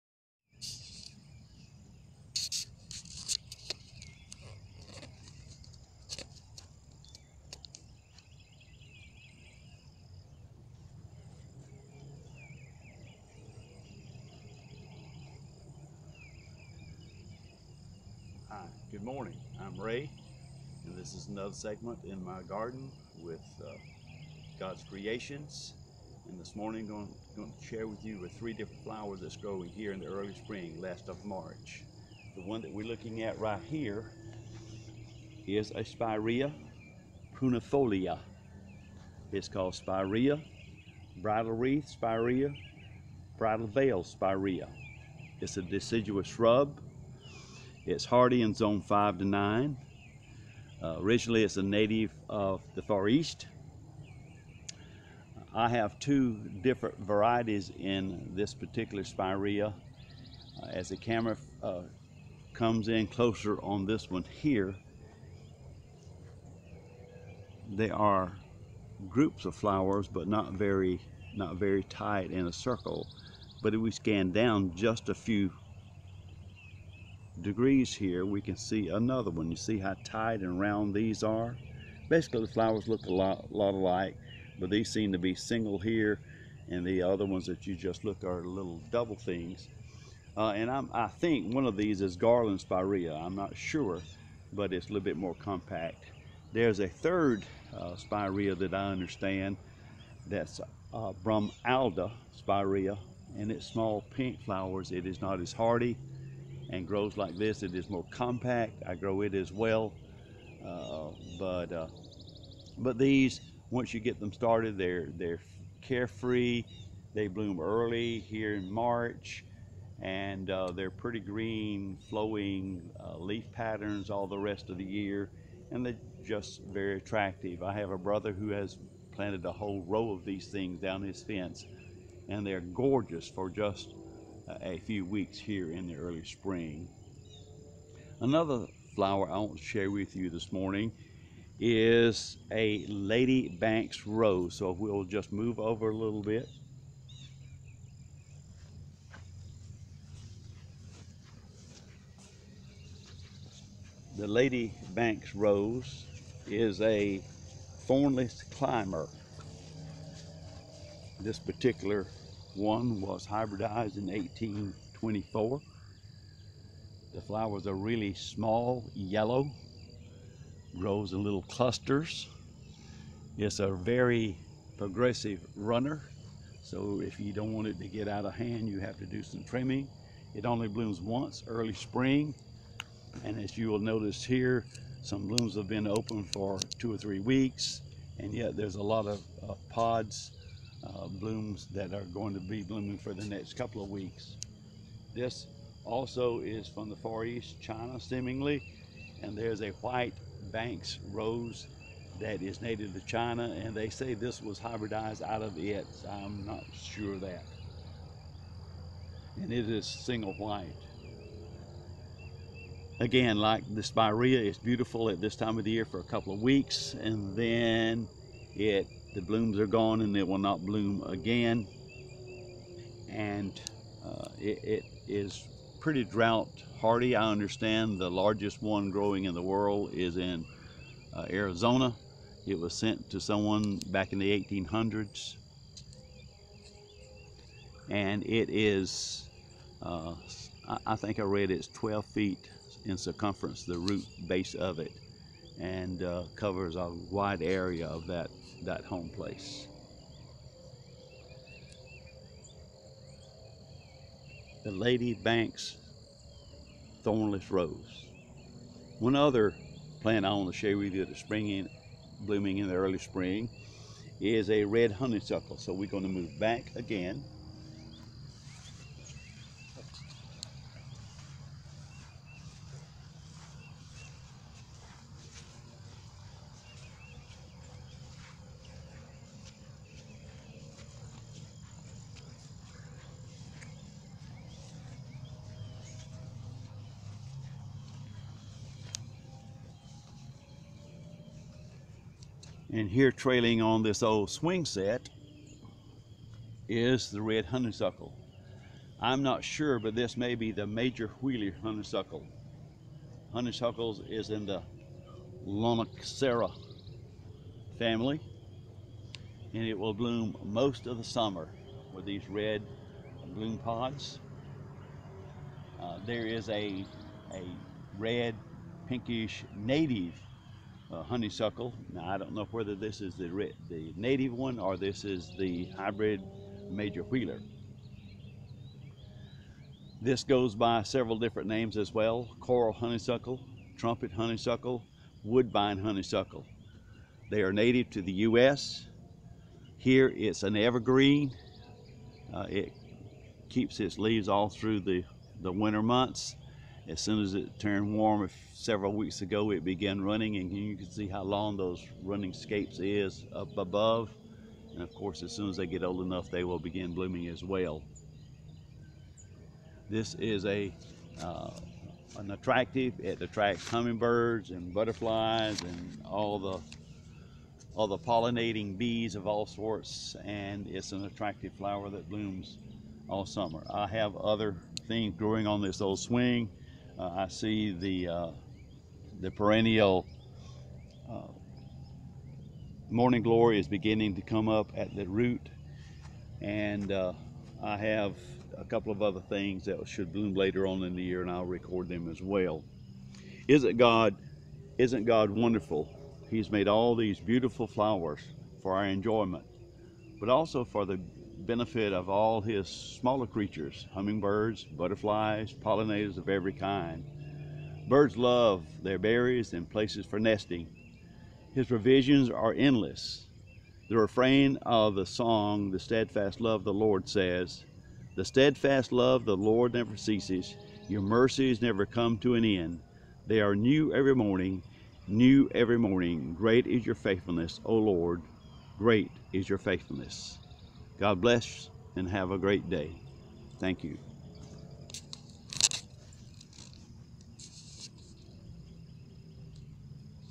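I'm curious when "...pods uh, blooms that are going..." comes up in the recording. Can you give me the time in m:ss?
3:09.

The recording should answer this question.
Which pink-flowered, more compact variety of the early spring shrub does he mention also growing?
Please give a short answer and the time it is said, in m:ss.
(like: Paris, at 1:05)
Bumalda Spirea, at 1:41.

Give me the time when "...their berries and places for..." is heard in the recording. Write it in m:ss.
6:48.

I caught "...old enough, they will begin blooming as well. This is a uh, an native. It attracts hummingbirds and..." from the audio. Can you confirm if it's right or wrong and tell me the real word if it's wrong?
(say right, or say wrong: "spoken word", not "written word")
wrong: "attractive", not "native".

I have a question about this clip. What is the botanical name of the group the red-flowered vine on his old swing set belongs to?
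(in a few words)
Lonicera.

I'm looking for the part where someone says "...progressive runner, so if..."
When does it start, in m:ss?
2:54.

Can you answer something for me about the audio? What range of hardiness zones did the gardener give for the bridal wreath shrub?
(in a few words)
5 to 9.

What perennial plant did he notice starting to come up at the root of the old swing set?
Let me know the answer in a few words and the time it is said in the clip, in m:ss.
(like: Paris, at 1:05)
morning glory, at 6:22.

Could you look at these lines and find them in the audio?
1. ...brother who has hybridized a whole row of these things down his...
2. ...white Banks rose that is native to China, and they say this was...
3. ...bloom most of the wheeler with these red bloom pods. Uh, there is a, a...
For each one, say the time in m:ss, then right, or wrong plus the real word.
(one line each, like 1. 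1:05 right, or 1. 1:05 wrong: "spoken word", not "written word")
1. 2:07 wrong: "planted", not "hybridized"
2. 3:19 right
3. 5:09 wrong: "summer", not "wheeler".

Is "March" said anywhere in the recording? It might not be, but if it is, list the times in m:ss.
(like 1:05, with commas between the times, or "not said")
0:31, 1:58.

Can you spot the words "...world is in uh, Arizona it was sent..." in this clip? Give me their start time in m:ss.
3:49.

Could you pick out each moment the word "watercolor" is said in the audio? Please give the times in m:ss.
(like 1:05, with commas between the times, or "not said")
not said.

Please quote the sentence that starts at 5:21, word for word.
Now I don't know whether this is the, the native one or this is the hybrid Major Wheeler.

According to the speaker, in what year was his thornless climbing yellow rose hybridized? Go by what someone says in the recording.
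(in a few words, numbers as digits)
1824.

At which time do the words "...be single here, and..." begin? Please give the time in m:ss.
1:25.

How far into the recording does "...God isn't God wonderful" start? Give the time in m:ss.
6:33.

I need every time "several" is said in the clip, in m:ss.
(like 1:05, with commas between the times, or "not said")
5:30, 5:48.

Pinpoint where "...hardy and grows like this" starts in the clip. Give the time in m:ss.
1:45.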